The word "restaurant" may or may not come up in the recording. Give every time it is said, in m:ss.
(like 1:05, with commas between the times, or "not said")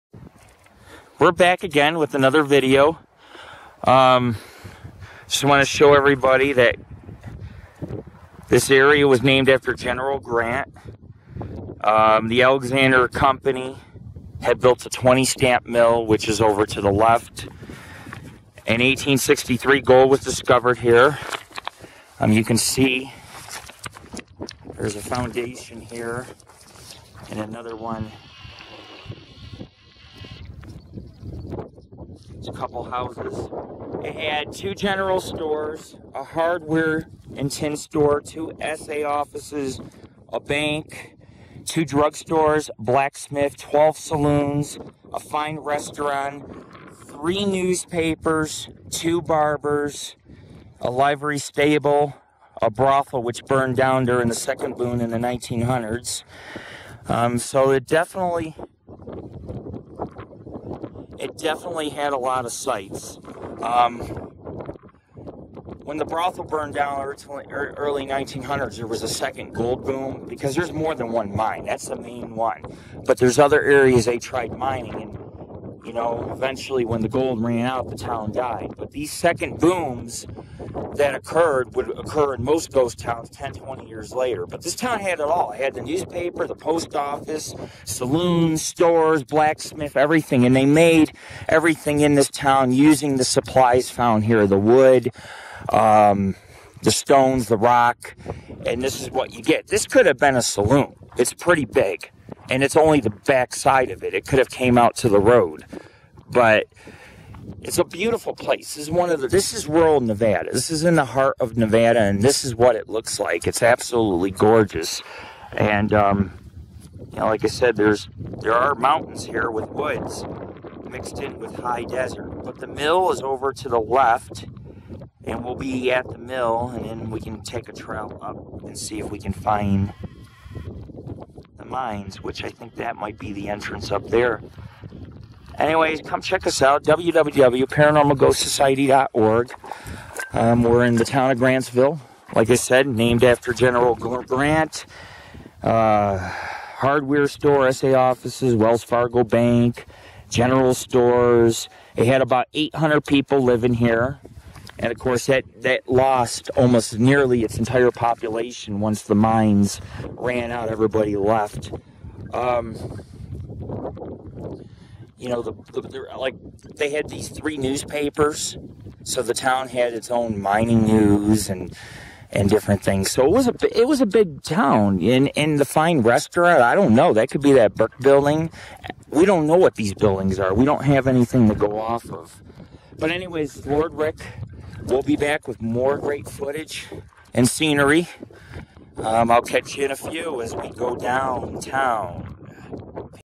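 0:45, 2:55.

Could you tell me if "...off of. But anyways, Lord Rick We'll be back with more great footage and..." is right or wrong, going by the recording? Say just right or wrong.
right.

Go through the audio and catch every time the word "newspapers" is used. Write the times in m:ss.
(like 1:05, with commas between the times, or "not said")
0:47, 1:25, 2:47.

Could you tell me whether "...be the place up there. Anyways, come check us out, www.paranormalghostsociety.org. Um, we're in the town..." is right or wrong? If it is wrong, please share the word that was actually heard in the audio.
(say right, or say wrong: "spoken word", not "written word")
wrong: "entrance", not "place".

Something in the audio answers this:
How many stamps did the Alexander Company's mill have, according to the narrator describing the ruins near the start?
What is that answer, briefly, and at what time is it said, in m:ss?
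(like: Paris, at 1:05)
20, at 0:14.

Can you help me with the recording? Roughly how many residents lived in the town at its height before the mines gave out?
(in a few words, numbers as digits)
800.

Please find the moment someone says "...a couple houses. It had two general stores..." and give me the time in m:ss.
0:32.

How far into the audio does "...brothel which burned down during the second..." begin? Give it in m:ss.
0:52.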